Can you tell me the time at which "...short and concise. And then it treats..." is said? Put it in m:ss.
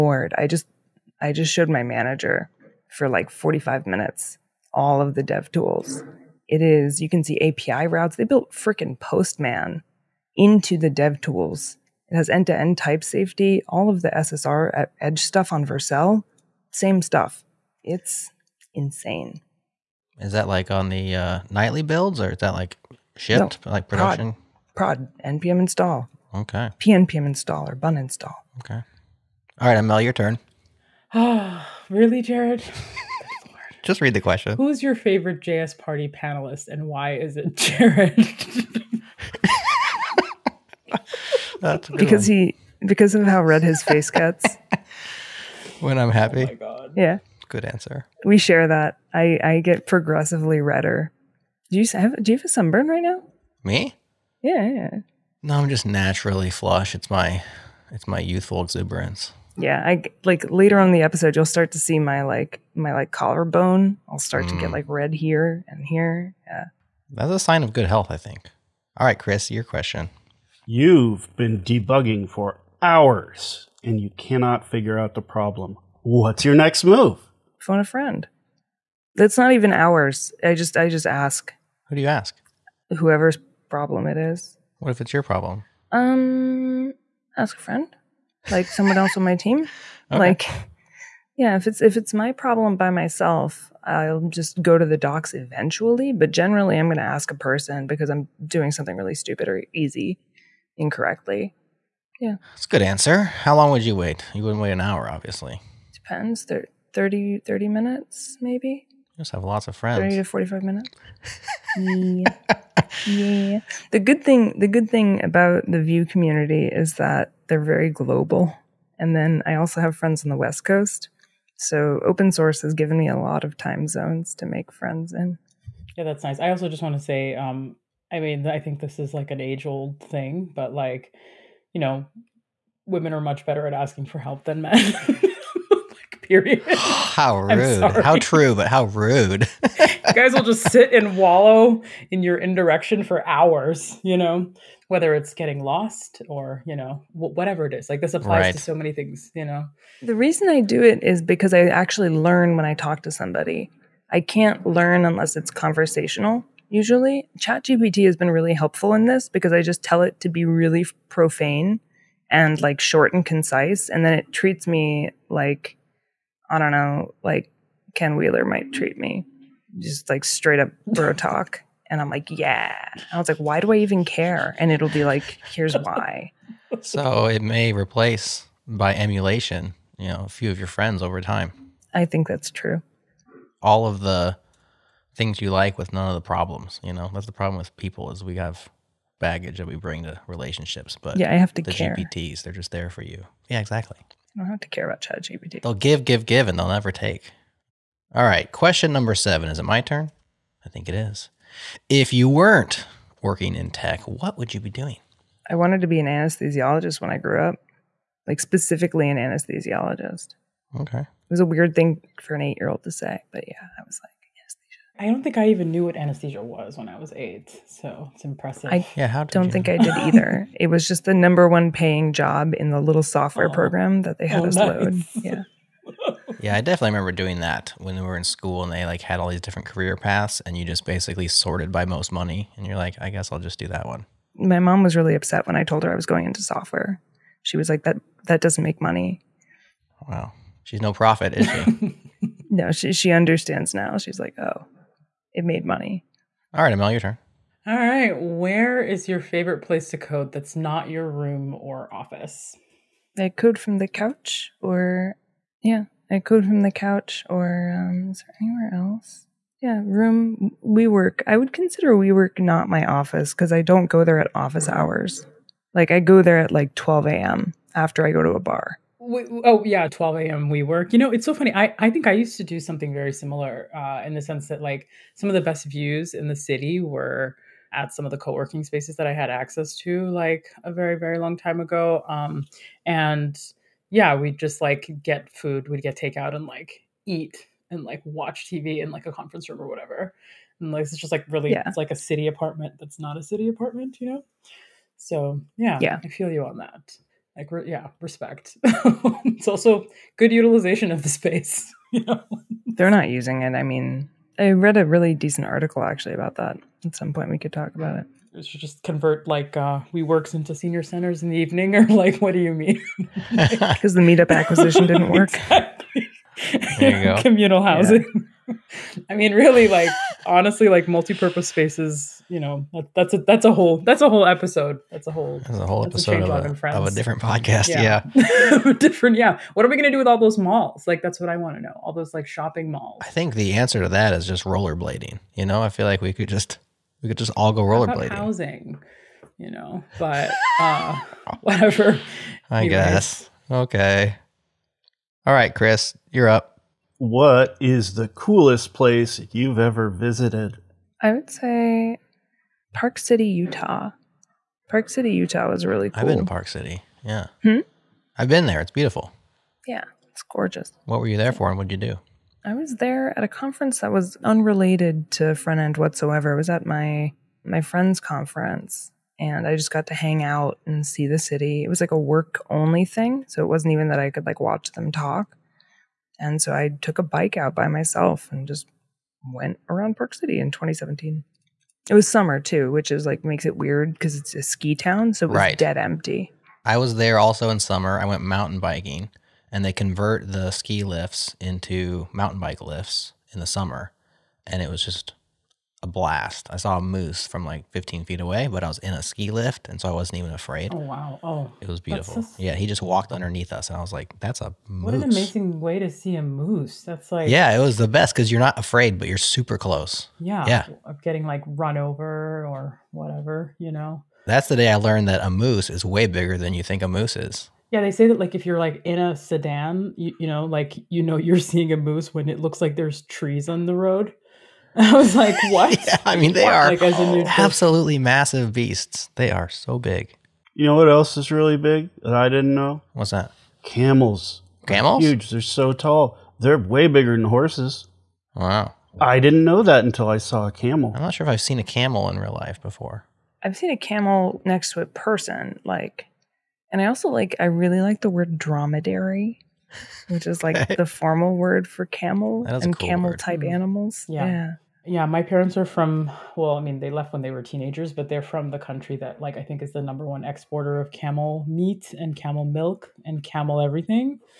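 2:42.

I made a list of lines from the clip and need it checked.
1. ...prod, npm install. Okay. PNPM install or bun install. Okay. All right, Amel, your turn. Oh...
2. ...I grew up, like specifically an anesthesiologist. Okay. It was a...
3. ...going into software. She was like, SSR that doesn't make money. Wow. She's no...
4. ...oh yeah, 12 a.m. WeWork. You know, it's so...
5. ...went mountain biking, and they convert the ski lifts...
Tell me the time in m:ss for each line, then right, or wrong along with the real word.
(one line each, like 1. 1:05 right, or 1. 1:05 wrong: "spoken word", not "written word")
1. 0:25 right
2. 3:27 right
3. 3:56 wrong: "That", not "SSR"
4. 4:29 right
5. 6:28 right.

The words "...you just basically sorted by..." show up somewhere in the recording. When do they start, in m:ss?
3:50.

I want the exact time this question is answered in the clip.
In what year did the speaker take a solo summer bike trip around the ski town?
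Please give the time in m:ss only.
6:20.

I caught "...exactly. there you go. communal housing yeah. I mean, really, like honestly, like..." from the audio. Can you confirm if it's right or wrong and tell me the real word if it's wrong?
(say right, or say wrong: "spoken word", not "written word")
right.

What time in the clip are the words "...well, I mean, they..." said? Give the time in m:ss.
7:36.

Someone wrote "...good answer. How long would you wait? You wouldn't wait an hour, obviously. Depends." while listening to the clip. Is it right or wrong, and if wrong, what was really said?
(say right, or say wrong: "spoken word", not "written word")
right.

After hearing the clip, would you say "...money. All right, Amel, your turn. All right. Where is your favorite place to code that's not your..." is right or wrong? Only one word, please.
right.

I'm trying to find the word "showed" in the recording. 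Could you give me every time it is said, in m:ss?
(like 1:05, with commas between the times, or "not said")
0:01.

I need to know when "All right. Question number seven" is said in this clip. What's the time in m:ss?
3:18.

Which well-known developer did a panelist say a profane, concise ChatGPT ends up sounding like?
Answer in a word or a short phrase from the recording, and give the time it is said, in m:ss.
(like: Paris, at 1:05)
Ken Wheeler, at 2:47.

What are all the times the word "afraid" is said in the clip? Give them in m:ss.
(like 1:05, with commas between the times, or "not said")
6:40, 6:48.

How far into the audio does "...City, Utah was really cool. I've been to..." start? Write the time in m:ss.
5:54.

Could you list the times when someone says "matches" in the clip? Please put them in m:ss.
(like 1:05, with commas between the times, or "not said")
not said.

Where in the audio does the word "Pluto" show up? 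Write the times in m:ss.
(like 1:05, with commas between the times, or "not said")
not said.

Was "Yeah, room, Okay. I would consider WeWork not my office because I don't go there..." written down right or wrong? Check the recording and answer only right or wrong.
wrong.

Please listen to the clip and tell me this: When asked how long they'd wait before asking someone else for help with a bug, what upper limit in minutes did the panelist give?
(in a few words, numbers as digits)
45.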